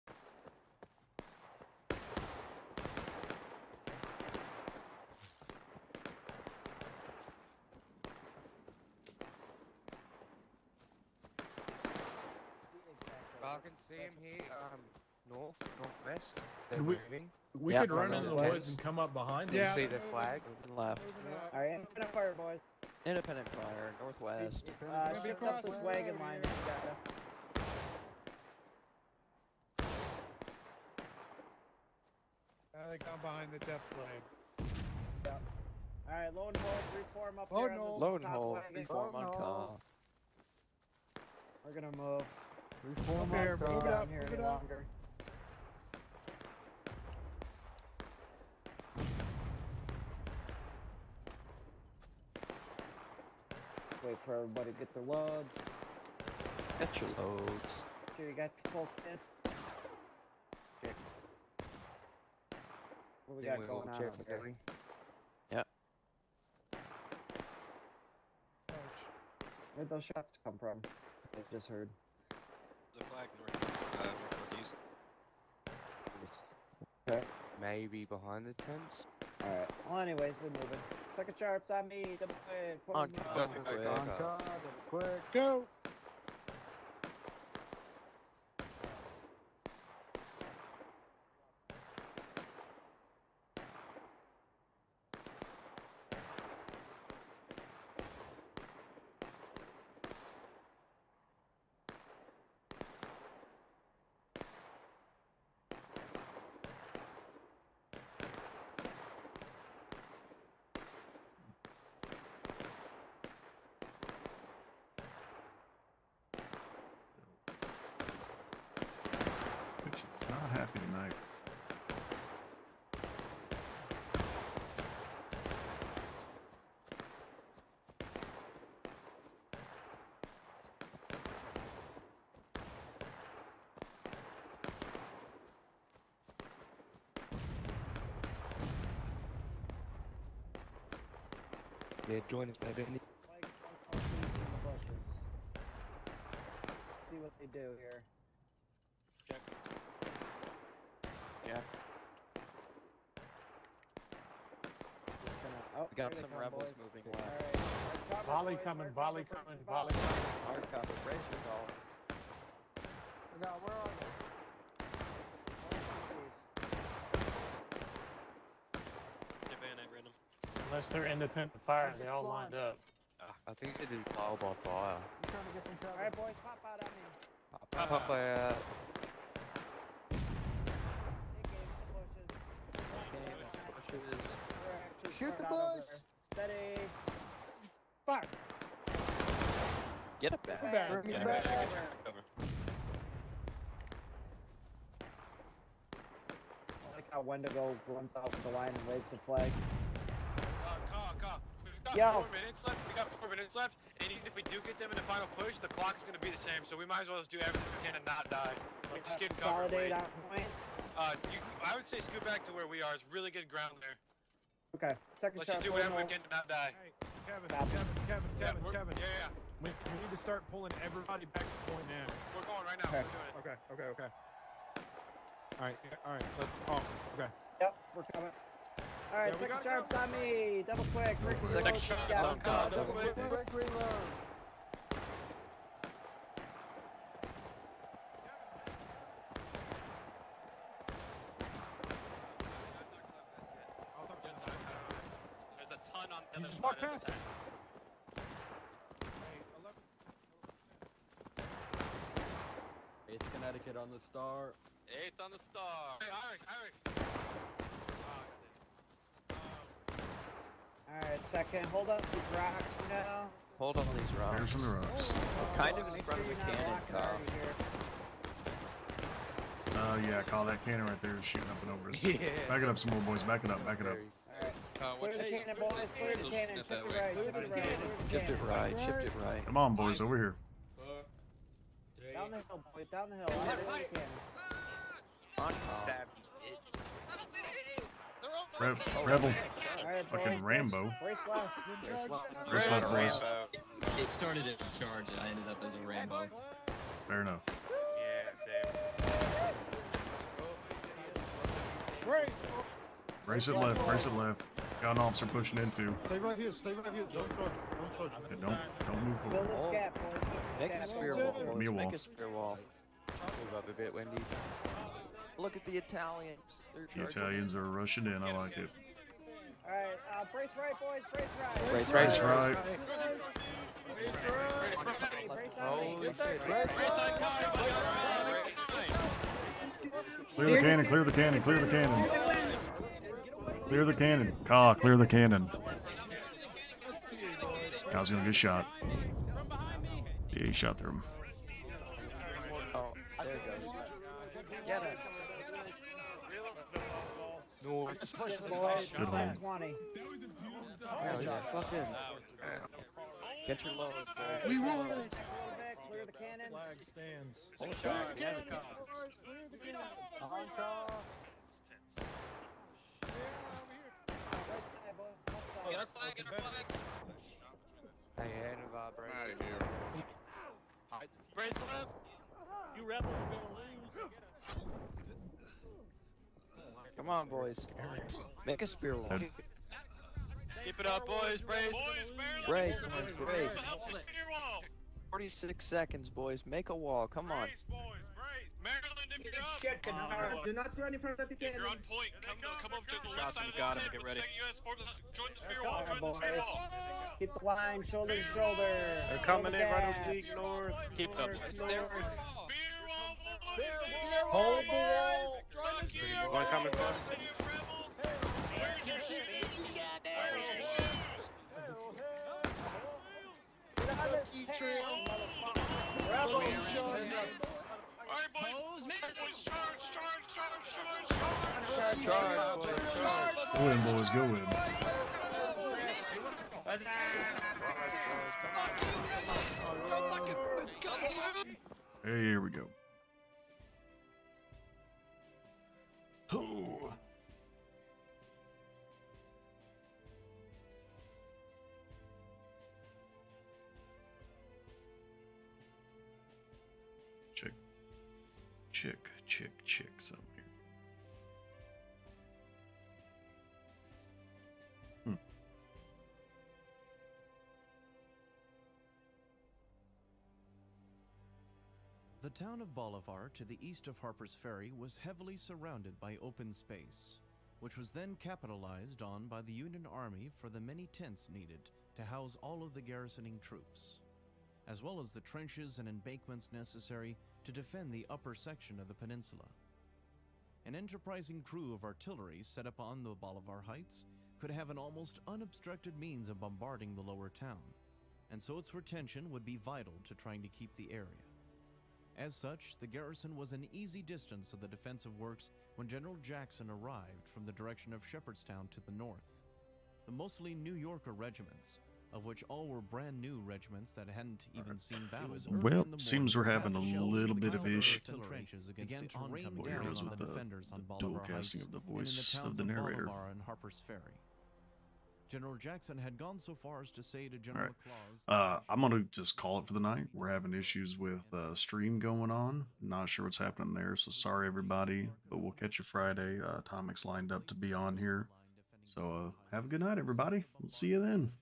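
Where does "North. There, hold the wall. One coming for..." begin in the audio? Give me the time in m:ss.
6:41.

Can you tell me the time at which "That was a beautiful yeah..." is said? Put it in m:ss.
5:49.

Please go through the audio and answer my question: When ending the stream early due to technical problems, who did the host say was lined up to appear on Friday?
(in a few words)
Atomic.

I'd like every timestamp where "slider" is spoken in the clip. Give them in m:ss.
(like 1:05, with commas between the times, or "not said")
not said.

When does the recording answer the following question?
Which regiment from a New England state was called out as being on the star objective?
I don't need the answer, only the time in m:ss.
4:13.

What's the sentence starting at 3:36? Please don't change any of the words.
Hey, Kevin, Kevin, Kevin, Kevin, yeah, Kevin.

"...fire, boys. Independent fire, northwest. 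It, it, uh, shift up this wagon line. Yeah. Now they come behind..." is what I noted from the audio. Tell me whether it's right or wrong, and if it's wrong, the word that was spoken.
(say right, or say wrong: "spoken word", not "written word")
right.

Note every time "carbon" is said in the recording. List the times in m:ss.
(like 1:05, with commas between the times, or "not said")
not said.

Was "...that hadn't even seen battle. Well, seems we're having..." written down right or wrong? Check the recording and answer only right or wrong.
right.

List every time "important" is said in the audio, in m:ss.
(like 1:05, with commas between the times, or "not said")
not said.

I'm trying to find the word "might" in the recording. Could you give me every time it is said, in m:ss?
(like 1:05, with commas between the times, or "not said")
3:26.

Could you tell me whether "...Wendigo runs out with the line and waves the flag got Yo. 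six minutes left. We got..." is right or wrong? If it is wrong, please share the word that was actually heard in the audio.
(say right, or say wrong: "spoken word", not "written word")
wrong: "four", not "six".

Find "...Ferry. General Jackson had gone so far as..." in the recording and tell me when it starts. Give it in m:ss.
8:33.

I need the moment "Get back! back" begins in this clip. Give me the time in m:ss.
3:11.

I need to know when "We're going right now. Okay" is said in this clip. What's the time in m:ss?
3:42.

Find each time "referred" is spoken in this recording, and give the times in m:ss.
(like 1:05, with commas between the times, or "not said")
not said.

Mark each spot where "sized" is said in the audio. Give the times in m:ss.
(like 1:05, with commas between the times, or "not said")
not said.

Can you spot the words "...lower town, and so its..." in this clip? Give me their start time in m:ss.
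8:07.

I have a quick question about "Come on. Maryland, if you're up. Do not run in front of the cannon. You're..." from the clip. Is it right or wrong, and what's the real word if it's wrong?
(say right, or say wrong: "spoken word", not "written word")
right.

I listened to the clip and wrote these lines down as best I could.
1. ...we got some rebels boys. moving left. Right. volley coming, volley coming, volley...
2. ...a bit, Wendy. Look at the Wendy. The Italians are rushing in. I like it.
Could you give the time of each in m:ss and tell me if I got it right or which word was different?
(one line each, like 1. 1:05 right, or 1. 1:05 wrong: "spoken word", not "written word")
1. 2:35 right
2. 5:13 wrong: "Italians", not "Wendy".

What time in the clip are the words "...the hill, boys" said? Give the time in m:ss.
4:42.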